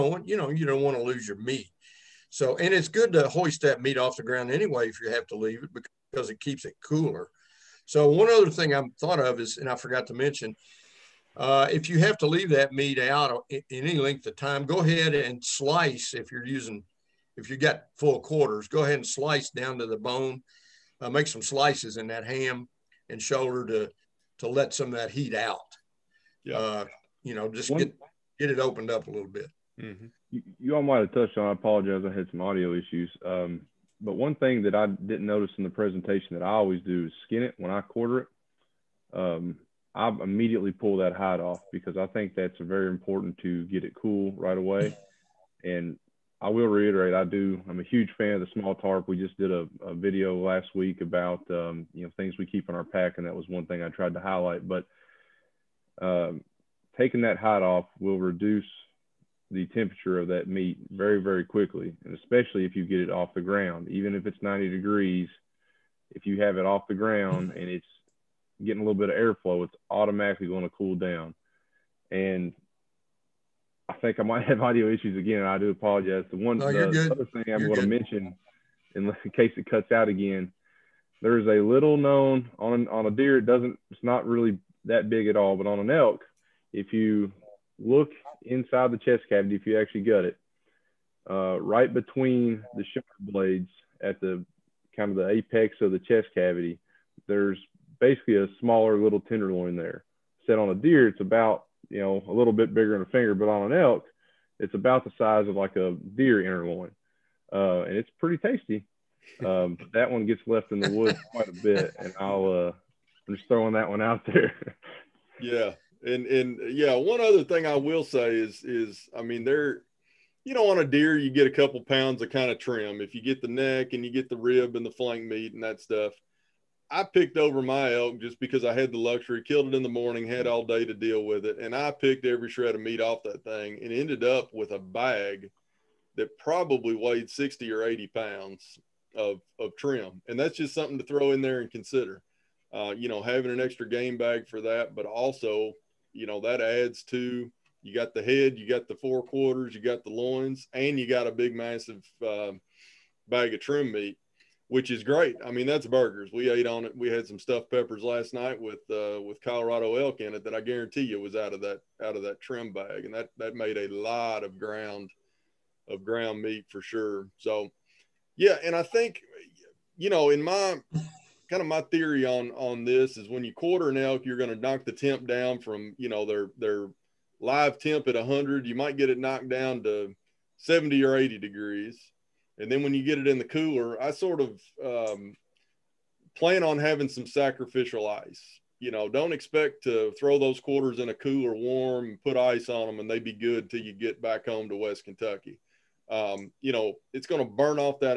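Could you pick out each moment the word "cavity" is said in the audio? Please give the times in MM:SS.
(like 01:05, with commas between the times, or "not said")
01:29, 01:36.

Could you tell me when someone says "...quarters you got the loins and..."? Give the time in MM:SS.
02:29.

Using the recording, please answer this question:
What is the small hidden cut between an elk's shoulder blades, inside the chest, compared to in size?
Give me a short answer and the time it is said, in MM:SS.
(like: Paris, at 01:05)
a deer tenderloin, at 01:45.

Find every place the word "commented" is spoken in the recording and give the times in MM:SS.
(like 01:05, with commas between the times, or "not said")
not said.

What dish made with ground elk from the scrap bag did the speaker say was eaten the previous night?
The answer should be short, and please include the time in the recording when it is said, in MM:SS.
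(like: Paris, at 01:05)
stuffed peppers, at 02:37.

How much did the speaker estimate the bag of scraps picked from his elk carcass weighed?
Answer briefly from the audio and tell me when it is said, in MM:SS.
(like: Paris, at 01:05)
60 or 80 pounds, at 02:17.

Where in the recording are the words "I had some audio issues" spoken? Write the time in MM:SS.
00:32.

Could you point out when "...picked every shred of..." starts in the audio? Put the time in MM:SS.
02:11.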